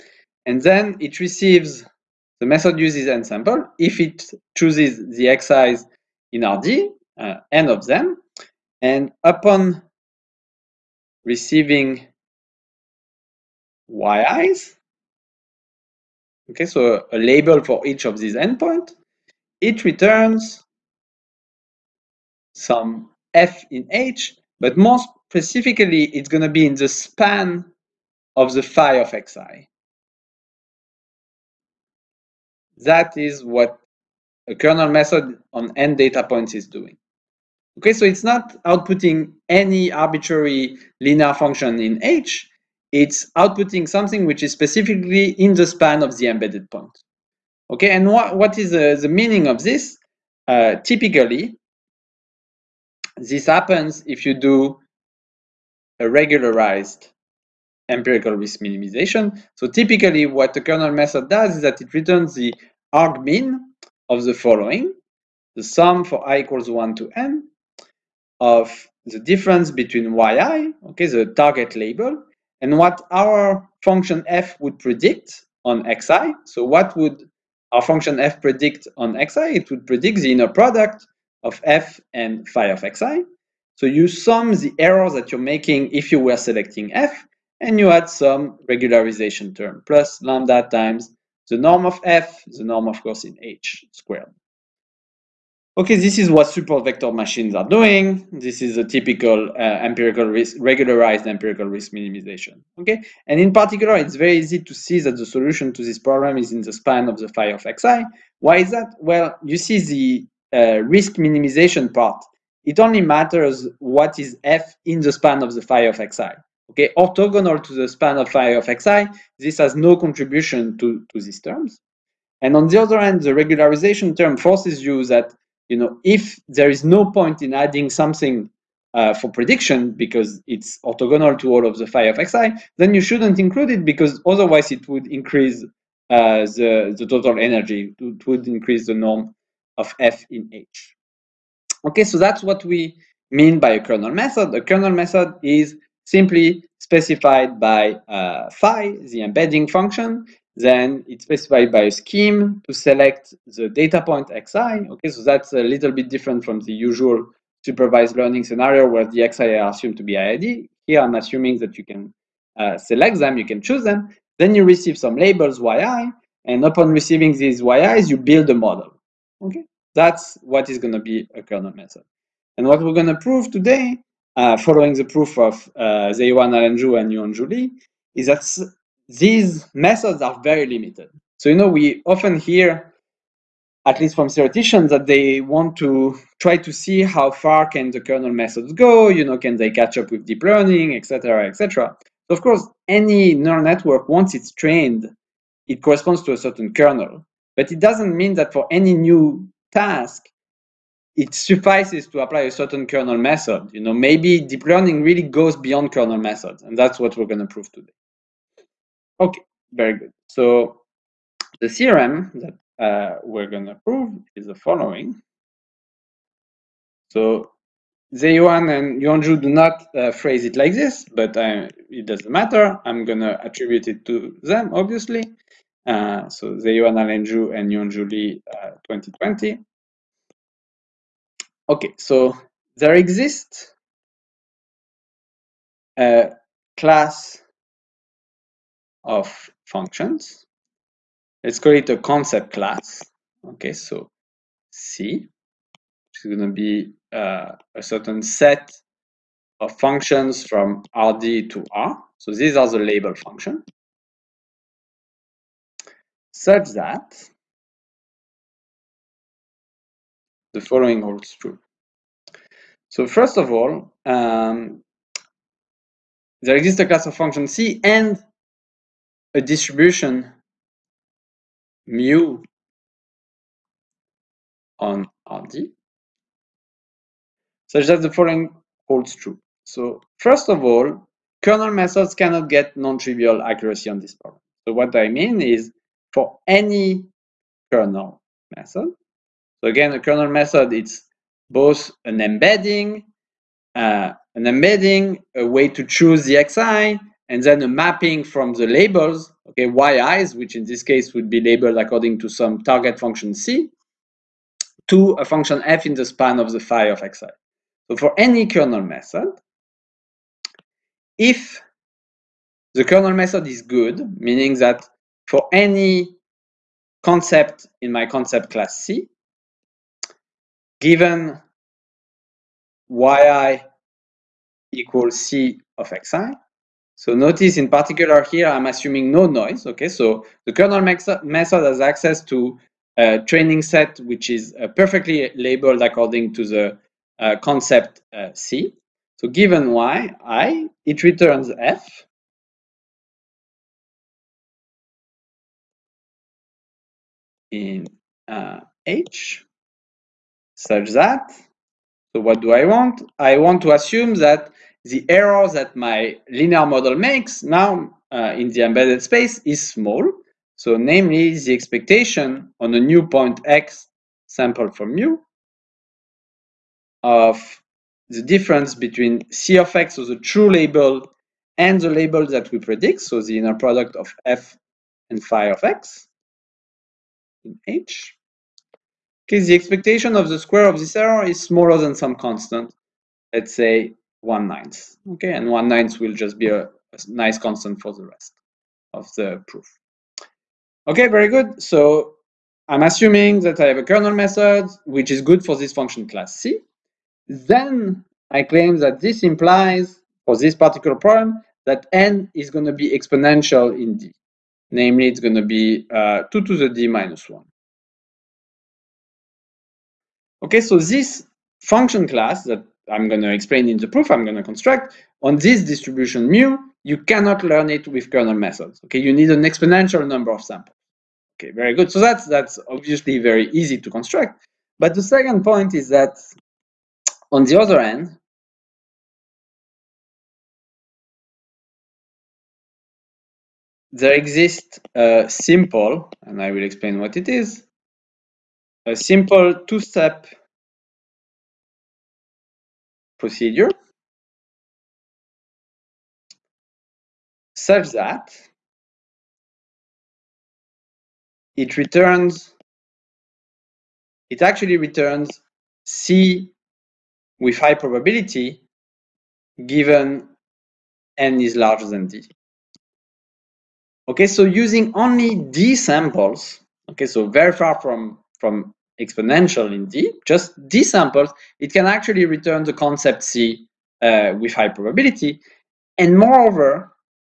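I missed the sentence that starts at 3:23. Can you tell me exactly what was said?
You know, maybe deep learning really goes beyond kernel methods, and that's what we're going to prove today.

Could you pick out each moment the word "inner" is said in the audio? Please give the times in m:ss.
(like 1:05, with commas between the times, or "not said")
1:20, 6:13.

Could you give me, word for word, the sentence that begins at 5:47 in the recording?
in uh, H such that, so what do I want?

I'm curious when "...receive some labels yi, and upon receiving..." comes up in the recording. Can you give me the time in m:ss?
2:44.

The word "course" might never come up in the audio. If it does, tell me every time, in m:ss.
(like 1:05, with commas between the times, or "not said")
1:33, 3:12.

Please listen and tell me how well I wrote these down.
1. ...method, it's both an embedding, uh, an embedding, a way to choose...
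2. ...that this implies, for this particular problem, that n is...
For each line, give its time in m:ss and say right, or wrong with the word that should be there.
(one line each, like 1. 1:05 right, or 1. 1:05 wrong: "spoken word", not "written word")
1. 4:50 right
2. 6:38 right.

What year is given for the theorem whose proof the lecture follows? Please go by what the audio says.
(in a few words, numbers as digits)
2020.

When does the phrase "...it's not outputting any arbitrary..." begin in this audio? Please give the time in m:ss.
0:38.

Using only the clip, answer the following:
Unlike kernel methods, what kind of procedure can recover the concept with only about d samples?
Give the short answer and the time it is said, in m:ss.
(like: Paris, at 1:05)
two-step procedure, at 7:19.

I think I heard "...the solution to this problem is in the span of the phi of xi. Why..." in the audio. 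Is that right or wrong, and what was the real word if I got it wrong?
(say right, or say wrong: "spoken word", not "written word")
right.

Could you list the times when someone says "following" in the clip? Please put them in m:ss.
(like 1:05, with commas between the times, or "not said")
1:04, 2:54, 3:34, 4:20, 4:38.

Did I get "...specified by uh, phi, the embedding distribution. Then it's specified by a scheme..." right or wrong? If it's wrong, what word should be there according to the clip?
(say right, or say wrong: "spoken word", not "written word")
wrong: "function", not "distribution".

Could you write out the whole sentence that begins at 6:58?
Okay, you need an exponential number of samples.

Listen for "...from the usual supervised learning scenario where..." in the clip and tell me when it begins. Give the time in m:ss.
2:36.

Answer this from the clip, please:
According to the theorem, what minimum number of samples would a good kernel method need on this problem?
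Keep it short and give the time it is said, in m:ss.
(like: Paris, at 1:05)
2^(d-1), at 6:46.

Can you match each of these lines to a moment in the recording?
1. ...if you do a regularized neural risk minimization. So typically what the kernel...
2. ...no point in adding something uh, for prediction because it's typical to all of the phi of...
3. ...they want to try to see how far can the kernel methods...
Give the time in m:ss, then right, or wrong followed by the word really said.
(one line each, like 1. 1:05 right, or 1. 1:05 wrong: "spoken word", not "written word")
1. 0:54 wrong: "empirical", not "neural"
2. 2:06 wrong: "orthogonal", not "typical"
3. 3:05 right.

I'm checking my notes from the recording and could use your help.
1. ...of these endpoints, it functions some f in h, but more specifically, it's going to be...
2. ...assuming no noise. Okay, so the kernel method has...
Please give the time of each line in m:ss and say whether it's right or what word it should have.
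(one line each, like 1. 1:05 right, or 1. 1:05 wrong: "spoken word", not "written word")
1. 0:18 wrong: "returns", not "functions"
2. 5:28 right.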